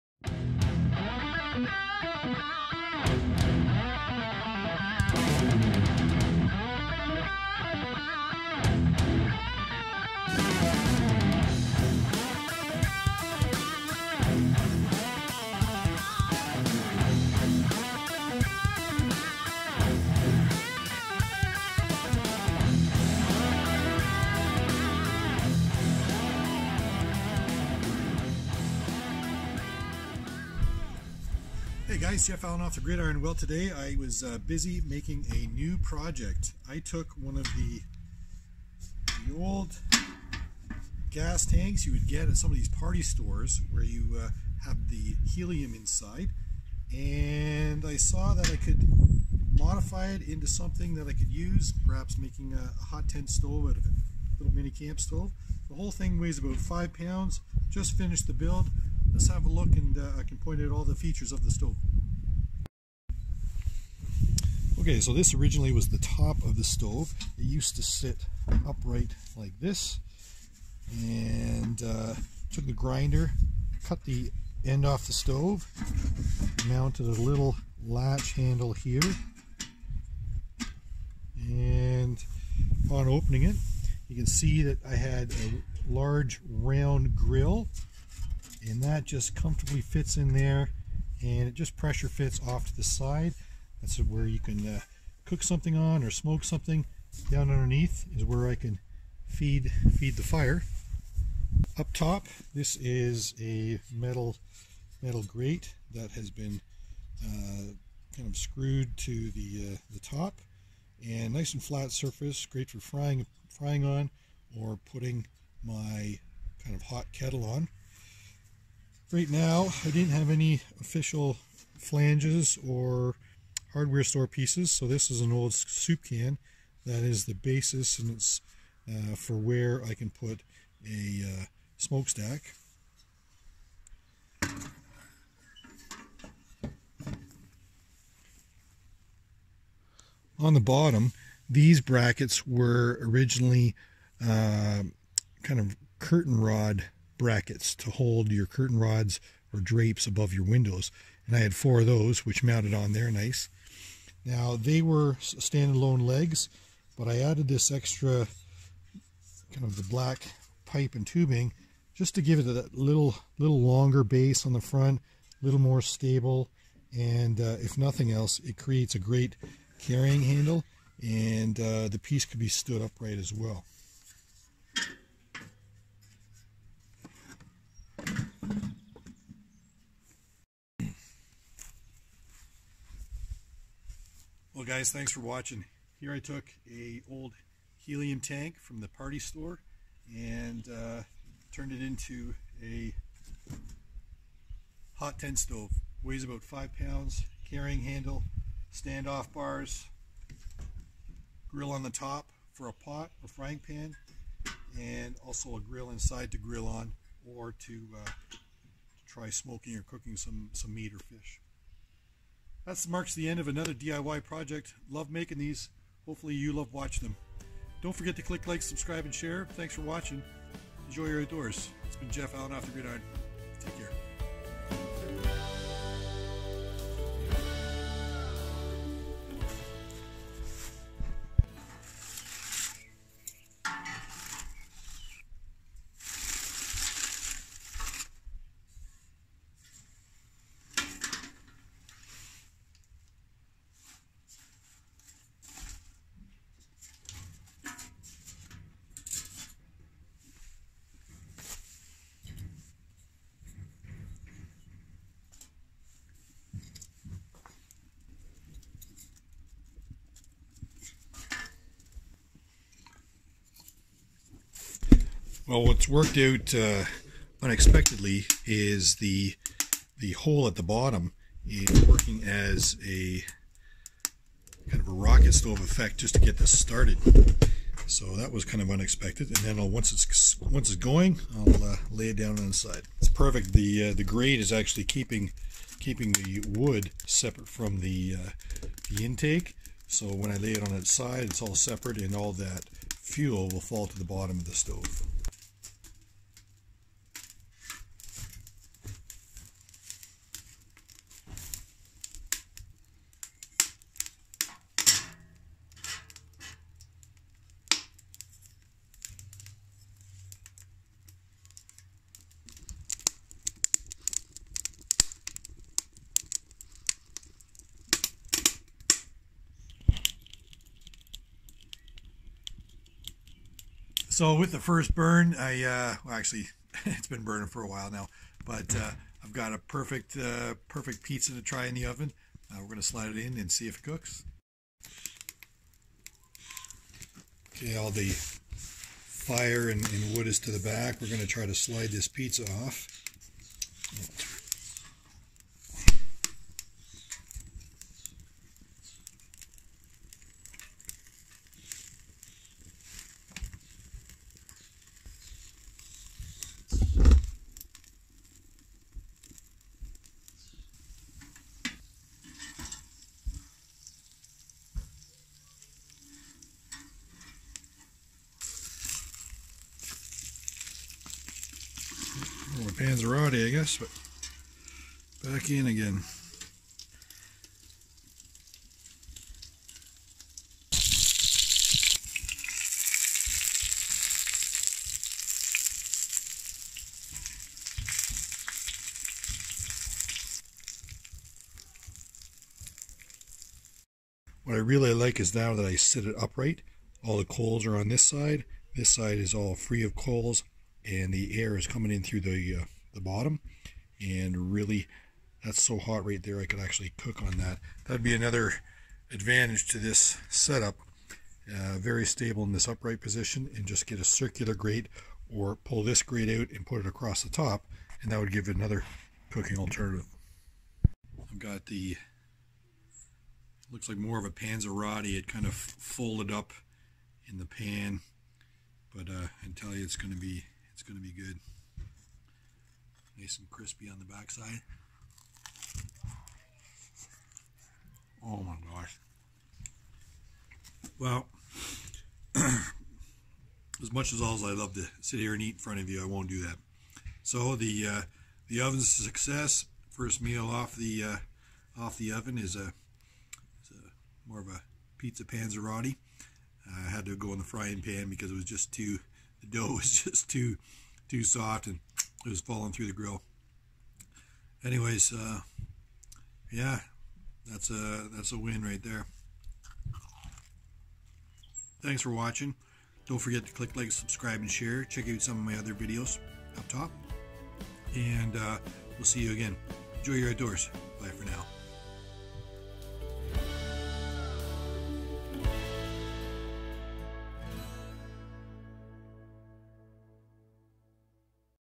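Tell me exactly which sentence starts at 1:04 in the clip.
Okay, so this originally was the top of the stove.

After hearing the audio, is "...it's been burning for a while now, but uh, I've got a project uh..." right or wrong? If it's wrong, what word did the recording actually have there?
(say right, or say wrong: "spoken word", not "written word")
wrong: "perfect", not "project".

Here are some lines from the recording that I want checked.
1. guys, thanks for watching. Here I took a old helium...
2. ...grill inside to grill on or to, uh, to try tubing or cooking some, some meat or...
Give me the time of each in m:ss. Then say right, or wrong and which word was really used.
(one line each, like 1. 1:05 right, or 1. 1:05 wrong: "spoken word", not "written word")
1. 3:04 right
2. 3:25 wrong: "smoking", not "tubing".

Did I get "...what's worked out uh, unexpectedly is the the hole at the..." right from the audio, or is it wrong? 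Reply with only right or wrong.
right.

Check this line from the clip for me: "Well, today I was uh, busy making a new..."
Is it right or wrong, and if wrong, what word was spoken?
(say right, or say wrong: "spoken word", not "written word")
right.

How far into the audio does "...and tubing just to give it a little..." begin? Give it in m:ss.
2:40.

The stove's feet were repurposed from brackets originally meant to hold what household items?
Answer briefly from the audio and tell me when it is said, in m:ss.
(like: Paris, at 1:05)
Curtain rods, at 2:28.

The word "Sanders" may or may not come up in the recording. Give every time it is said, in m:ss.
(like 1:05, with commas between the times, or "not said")
not said.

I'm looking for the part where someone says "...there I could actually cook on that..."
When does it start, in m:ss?
6:46.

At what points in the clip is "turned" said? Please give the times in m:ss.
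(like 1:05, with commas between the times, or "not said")
3:11.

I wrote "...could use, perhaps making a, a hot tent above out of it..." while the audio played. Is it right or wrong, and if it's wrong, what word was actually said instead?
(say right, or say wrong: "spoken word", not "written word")
wrong: "stove", not "above".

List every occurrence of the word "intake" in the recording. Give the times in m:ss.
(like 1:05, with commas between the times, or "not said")
4:49.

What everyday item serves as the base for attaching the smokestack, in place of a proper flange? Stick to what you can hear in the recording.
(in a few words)
Soup can.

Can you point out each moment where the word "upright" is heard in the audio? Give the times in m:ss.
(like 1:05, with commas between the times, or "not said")
1:08, 2:52, 6:36, 6:52.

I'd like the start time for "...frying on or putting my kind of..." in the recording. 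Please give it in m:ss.
1:53.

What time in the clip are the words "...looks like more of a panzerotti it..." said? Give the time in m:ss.
7:03.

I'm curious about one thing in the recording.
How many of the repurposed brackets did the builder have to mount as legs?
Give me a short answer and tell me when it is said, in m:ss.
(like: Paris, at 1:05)
4, at 2:31.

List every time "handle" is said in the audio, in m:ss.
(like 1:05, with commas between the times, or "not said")
1:18, 2:50, 3:17.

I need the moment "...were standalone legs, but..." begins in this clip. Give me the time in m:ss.
2:34.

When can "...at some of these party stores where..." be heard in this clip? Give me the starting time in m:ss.
0:42.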